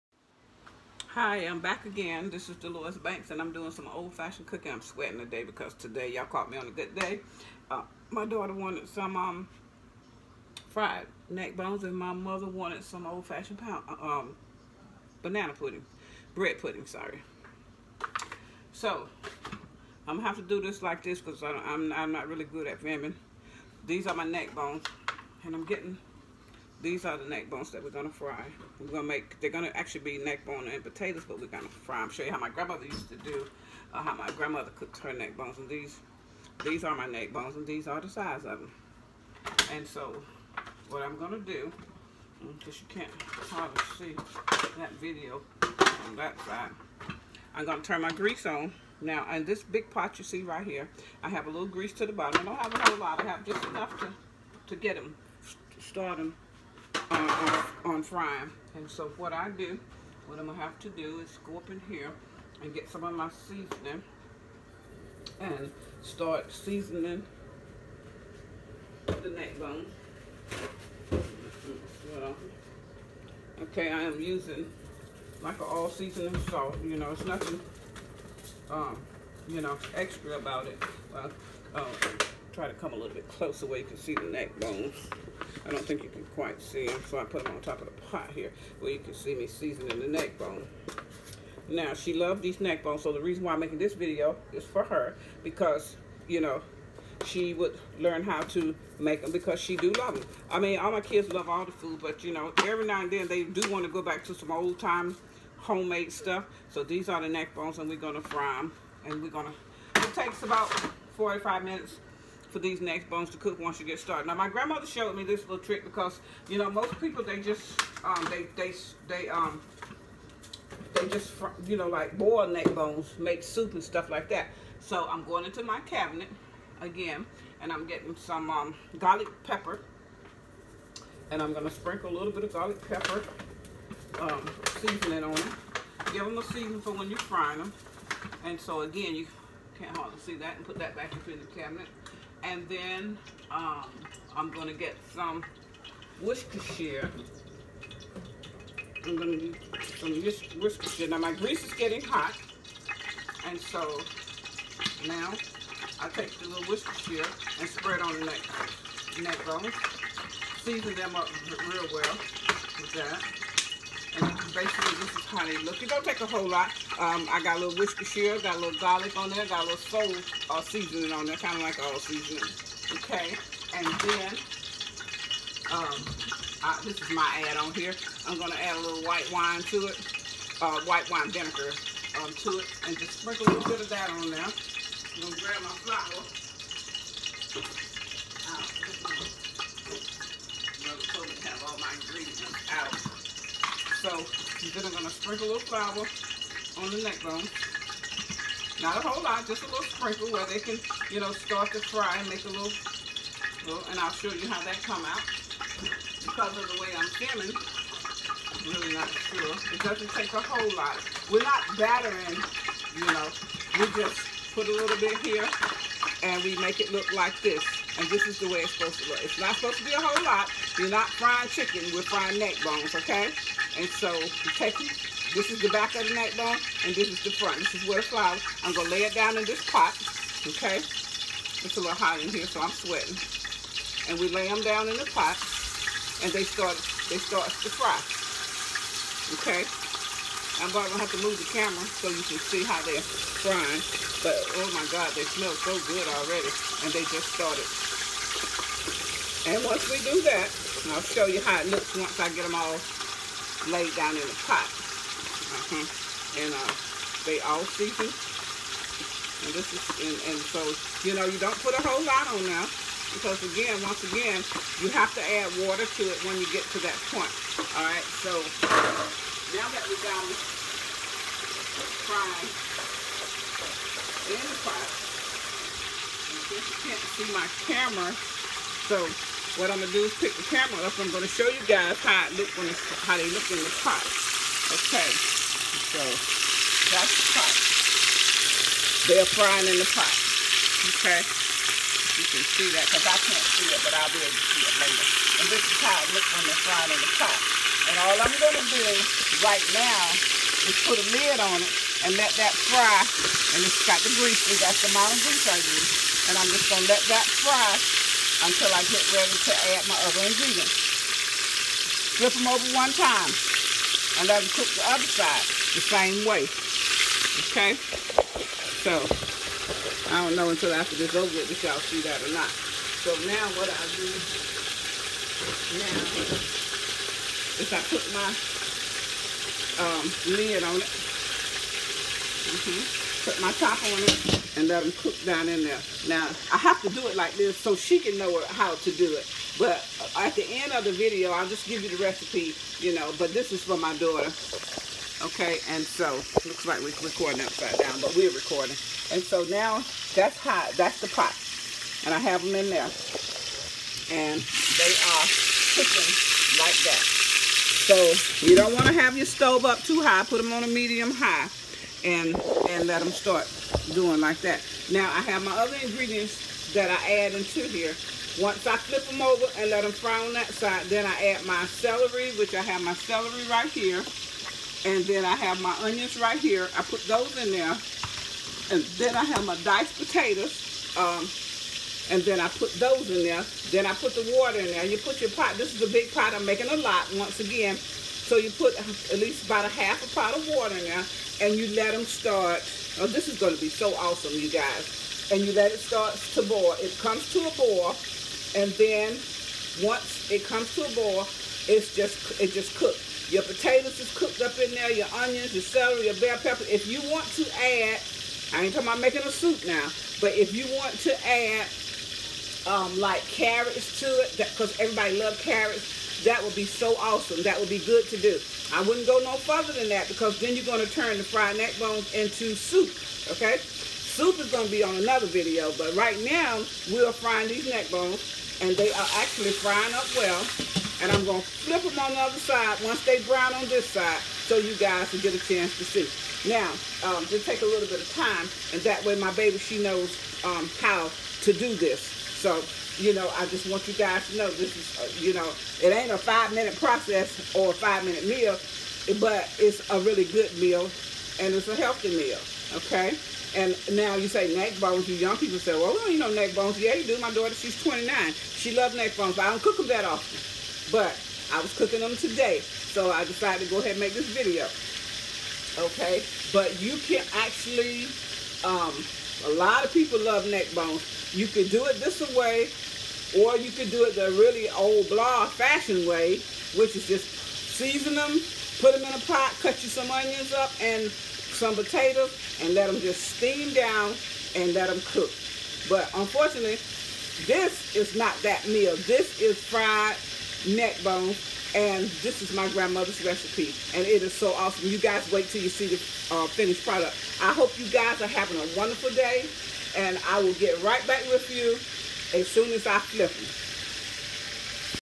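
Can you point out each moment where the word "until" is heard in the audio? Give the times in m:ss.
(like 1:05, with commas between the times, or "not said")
5:08, 5:20.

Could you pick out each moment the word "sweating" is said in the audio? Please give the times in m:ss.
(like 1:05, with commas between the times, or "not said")
0:04, 3:52.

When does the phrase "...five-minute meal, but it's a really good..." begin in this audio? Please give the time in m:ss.
7:27.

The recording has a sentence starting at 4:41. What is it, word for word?
I'm gonna show you guys how it look when it's, how they look in the pot the pot.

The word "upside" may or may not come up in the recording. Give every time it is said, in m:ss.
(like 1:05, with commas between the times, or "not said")
5:47.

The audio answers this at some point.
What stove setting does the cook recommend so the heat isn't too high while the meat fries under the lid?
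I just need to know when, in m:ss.
6:00.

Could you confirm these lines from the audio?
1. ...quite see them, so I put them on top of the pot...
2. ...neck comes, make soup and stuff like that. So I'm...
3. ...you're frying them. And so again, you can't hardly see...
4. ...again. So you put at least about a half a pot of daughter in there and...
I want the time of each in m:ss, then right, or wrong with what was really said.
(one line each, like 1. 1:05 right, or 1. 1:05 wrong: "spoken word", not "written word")
1. 1:26 right
2. 2:02 wrong: "bones", not "comes"
3. 2:17 right
4. 6:27 wrong: "water", not "daughter".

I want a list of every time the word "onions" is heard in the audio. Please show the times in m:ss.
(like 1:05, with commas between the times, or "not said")
6:15, 6:45, 8:00.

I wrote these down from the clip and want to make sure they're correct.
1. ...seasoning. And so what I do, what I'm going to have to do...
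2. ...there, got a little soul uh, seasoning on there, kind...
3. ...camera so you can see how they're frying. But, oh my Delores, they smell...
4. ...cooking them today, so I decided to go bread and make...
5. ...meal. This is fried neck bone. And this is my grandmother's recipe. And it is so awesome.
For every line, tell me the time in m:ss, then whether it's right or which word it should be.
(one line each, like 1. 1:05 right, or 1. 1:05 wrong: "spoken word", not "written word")
1. 0:58 wrong: "frying", not "seasoning"
2. 2:49 right
3. 4:01 wrong: "God", not "Delores"
4. 7:41 wrong: "ahead", not "bread"
5. 8:08 right.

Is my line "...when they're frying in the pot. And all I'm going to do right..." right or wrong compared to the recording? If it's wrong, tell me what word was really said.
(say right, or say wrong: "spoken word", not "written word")
right.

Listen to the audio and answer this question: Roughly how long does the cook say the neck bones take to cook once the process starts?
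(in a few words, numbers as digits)
45 minutes.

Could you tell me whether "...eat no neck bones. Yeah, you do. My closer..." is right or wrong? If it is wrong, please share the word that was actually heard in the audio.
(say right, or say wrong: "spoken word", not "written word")
wrong: "daughter", not "closer".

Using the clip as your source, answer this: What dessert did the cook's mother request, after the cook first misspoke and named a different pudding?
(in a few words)
bread pudding.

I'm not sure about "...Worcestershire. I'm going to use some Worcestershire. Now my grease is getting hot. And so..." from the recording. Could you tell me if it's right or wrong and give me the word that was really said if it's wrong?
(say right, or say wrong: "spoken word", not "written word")
right.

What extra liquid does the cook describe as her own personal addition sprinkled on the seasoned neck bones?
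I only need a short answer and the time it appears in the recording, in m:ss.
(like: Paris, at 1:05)
white wine vinegar, at 3:00.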